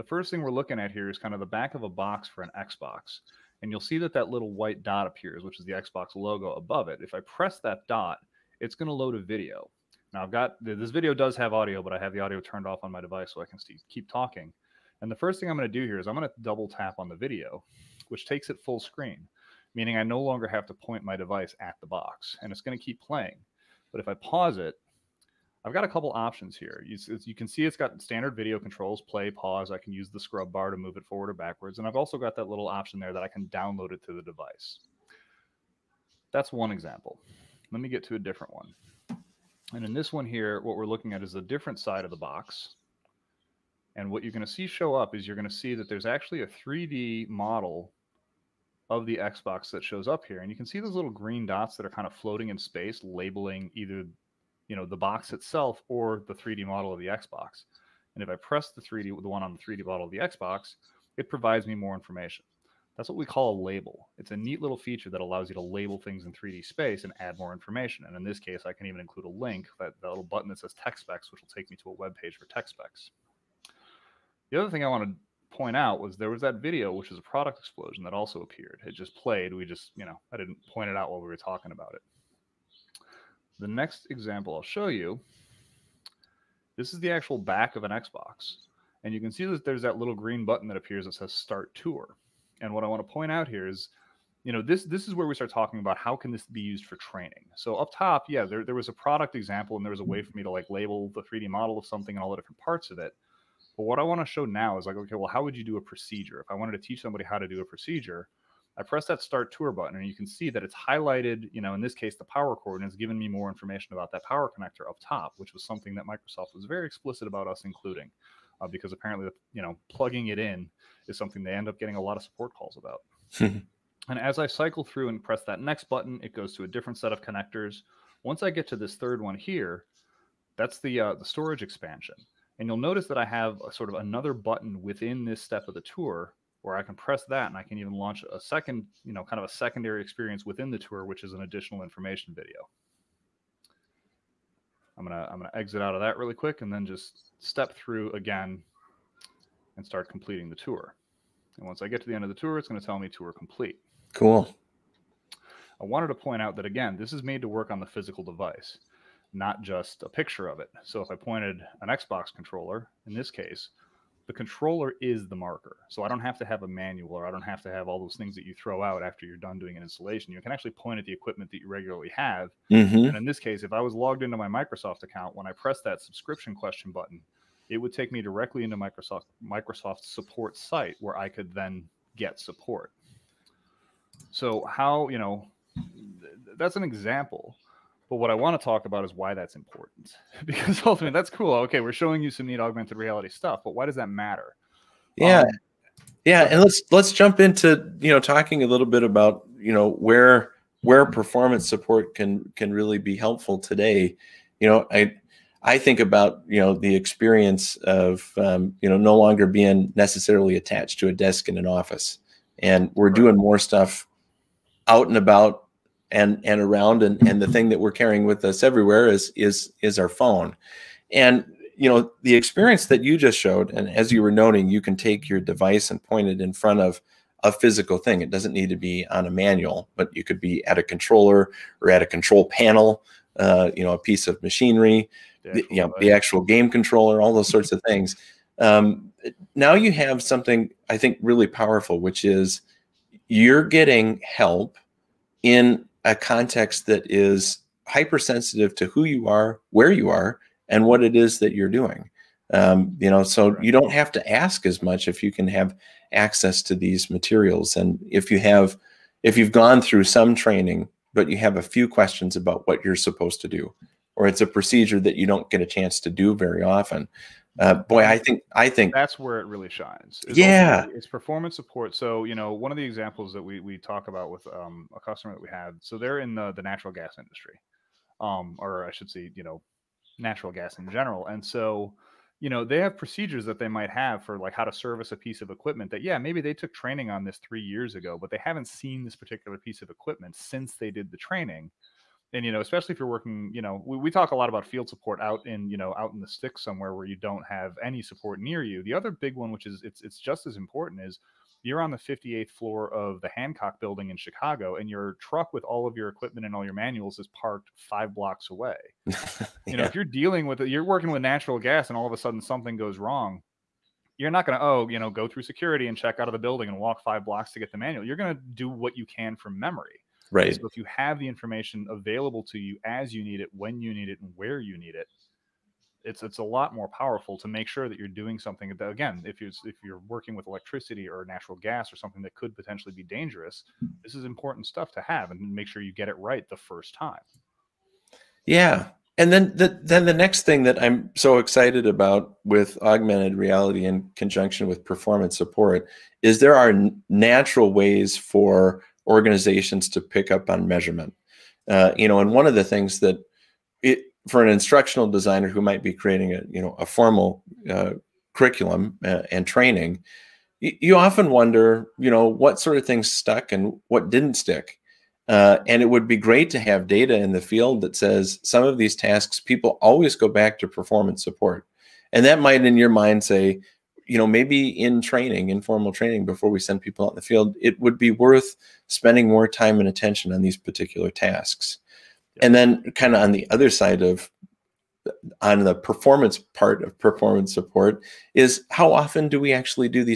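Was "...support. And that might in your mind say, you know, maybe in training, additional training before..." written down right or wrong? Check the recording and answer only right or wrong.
wrong.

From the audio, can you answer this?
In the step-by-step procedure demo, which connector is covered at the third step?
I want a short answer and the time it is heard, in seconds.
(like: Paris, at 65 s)
storage expansion, at 131 s.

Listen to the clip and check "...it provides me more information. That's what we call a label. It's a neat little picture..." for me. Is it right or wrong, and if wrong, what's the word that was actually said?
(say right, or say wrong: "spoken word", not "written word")
wrong: "feature", not "picture".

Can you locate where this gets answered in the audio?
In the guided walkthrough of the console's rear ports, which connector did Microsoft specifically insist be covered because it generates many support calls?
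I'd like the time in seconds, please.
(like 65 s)
112 s.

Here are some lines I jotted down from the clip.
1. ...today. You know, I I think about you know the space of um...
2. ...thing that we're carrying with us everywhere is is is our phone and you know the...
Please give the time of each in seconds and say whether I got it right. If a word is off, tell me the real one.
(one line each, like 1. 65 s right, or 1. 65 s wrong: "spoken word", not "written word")
1. 203 s wrong: "experience", not "space"
2. 217 s right.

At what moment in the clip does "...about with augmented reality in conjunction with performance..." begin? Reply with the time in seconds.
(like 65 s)
341 s.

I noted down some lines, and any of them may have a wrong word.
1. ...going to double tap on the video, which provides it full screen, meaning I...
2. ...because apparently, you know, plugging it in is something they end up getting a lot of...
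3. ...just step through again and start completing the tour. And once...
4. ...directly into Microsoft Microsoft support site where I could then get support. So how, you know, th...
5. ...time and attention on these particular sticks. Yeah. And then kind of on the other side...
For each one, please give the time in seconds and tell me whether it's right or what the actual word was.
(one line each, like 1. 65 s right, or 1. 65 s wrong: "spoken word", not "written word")
1. 16 s wrong: "takes", not "provides"
2. 118 s right
3. 146 s right
4. 178 s right
5. 379 s wrong: "tasks", not "sticks".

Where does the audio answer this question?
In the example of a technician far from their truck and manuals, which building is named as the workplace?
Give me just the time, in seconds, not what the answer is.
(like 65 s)
303 s.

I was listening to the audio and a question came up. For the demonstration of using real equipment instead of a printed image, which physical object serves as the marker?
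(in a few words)
Xbox controller.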